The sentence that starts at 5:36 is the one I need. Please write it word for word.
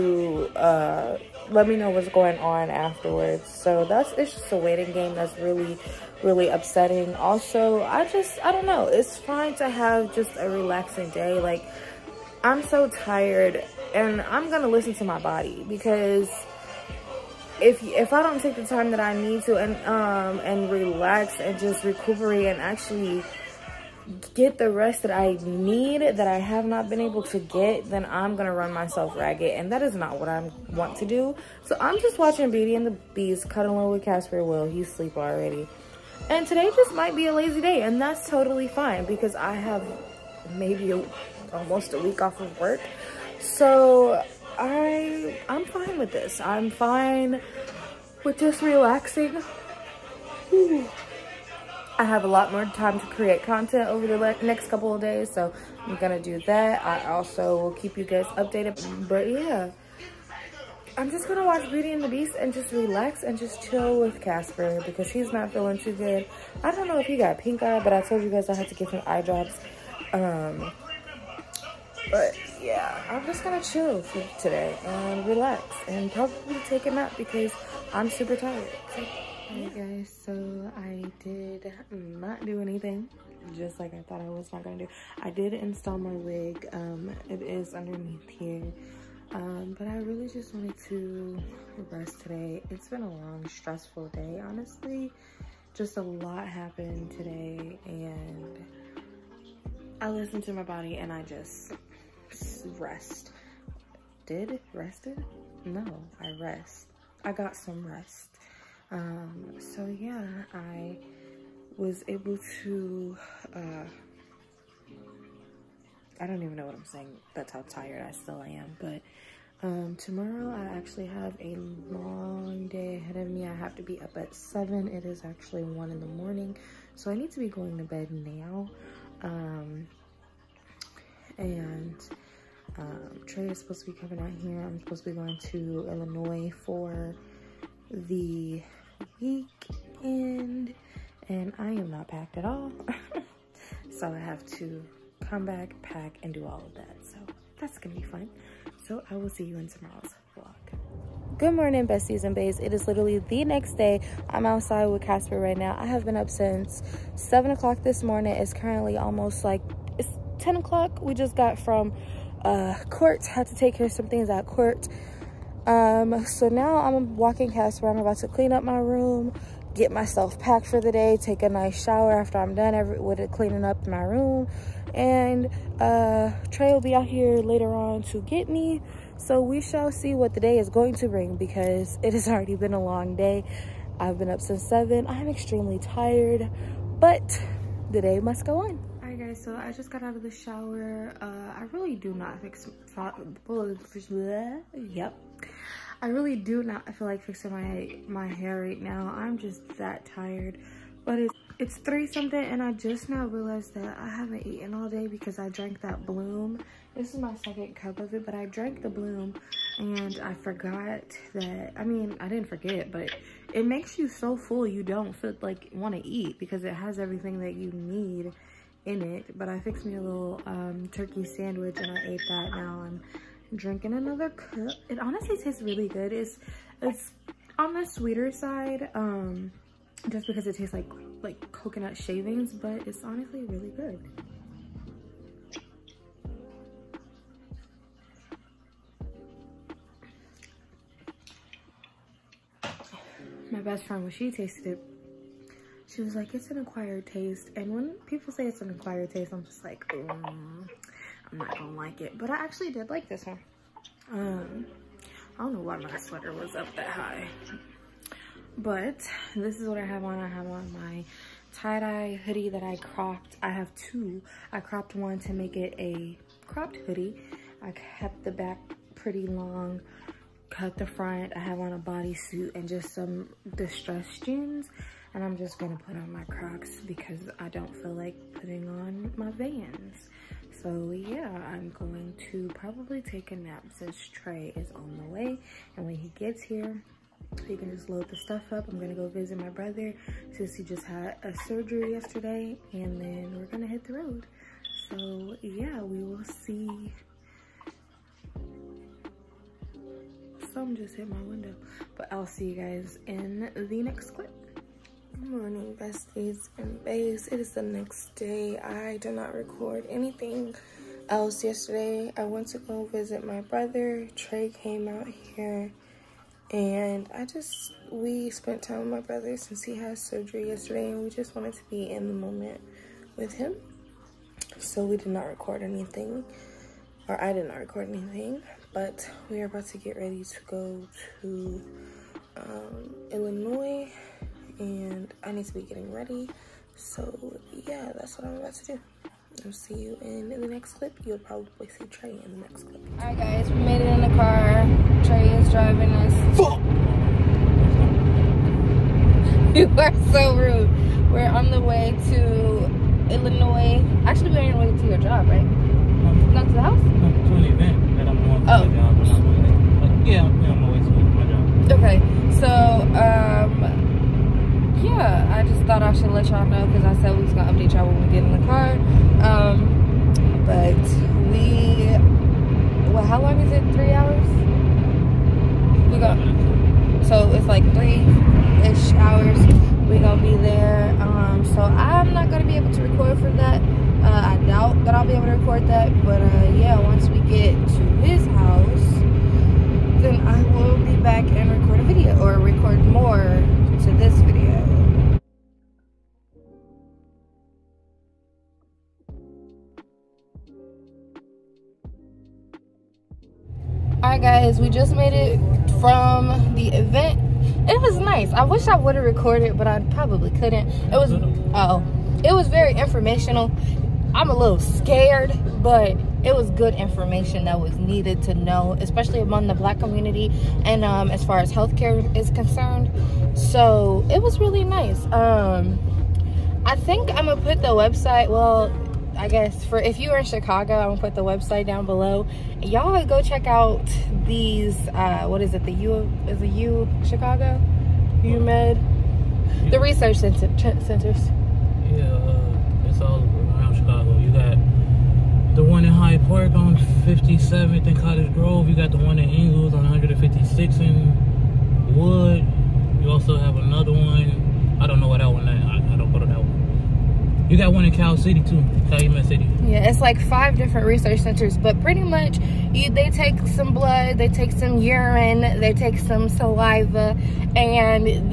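So yeah, that's what I'm about to do.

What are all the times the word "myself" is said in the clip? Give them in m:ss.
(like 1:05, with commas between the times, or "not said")
0:28, 2:49.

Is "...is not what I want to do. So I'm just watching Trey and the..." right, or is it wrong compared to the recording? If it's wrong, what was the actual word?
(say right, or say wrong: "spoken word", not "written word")
wrong: "Beauty", not "Trey".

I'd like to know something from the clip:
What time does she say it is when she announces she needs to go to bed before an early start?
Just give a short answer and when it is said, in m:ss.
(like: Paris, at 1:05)
1 in the morning, at 2:05.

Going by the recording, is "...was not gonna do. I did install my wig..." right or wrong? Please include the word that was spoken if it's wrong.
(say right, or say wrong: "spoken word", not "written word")
right.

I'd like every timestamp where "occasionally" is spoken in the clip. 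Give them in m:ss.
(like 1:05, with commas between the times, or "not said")
not said.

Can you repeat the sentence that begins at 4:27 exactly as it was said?
I kept the back pretty long, cut the front.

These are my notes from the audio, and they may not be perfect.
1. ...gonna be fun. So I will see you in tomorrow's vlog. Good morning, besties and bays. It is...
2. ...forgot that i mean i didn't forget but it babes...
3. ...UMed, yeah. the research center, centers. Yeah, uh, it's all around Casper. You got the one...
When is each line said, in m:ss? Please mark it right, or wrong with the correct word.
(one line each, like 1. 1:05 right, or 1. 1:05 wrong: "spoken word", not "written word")
1. 2:27 right
2. 3:30 wrong: "makes", not "babes"
3. 7:18 wrong: "Chicago", not "Casper".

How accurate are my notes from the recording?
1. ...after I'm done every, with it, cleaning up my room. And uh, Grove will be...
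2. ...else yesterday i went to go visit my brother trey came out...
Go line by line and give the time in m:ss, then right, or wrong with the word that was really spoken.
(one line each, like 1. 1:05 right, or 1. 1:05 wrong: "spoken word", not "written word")
1. 2:52 wrong: "Trey", not "Grove"
2. 5:11 right.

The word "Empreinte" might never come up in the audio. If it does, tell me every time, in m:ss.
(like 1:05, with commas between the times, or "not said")
not said.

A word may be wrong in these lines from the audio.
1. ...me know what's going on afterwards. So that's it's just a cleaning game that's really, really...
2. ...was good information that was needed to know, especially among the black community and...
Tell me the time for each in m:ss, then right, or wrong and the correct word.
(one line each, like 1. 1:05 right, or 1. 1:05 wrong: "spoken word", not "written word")
1. 0:01 wrong: "waiting", not "cleaning"
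2. 6:56 right.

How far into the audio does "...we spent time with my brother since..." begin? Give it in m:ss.
5:17.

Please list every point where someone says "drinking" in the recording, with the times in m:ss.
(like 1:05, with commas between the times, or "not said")
3:43.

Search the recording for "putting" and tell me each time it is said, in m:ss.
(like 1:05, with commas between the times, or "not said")
4:38.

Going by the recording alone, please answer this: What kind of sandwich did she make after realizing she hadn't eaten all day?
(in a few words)
turkey.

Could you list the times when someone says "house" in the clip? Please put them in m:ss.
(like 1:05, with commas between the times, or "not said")
5:56, 6:28.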